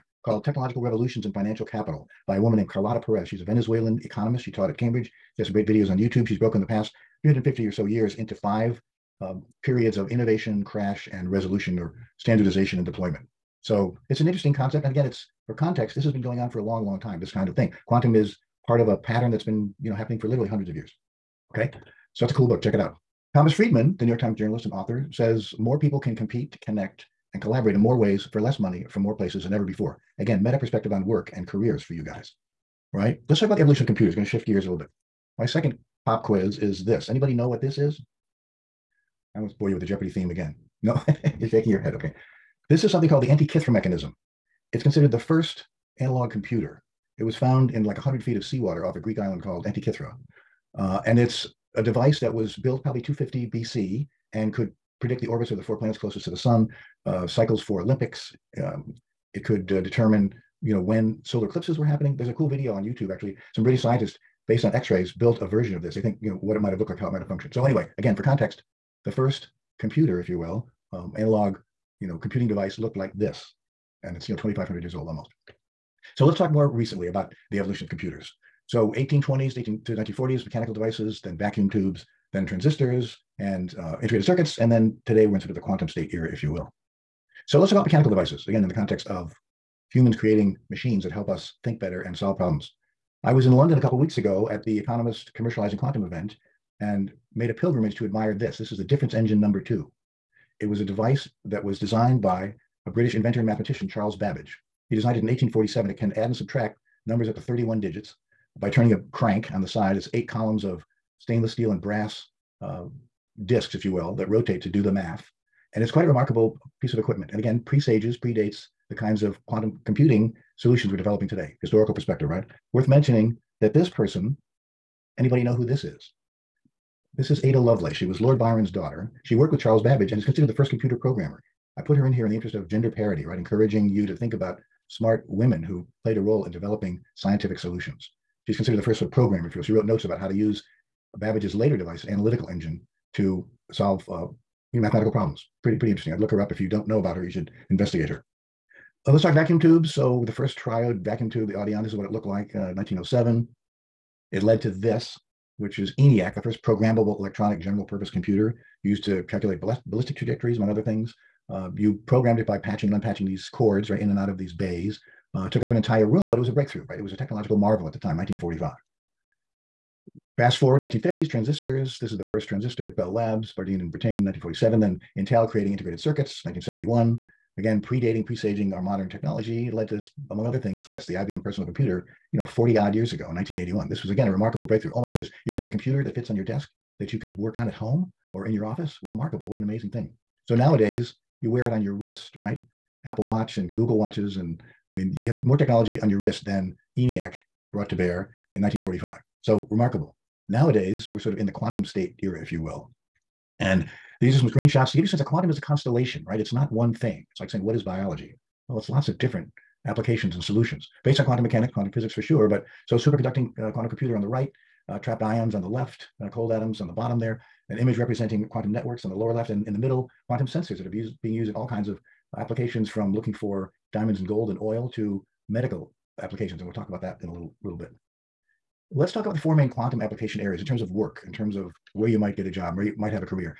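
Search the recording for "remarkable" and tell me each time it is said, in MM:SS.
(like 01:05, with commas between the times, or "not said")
01:56, 03:04, 03:09, 03:19.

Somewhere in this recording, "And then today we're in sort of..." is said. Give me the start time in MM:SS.
01:24.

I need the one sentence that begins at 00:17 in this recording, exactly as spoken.
Quantum is part of a pattern that's been, you know, happening for literally hundreds of years.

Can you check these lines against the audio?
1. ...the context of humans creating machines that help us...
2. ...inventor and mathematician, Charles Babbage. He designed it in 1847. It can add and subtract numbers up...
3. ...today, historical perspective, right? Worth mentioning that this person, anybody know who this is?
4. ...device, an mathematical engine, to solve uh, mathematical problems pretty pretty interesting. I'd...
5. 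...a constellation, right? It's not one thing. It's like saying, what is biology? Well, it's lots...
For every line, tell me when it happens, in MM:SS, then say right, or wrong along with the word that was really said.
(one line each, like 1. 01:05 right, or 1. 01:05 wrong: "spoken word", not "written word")
1. 01:28 right
2. 01:43 right
3. 02:01 right
4. 02:21 wrong: "analytical", not "mathematical"
5. 03:25 right.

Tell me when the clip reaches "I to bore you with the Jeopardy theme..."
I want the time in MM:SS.
00:39.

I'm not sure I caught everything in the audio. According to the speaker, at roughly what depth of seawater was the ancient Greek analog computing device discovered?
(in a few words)
100 feet.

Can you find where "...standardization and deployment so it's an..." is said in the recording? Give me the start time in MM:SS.
00:12.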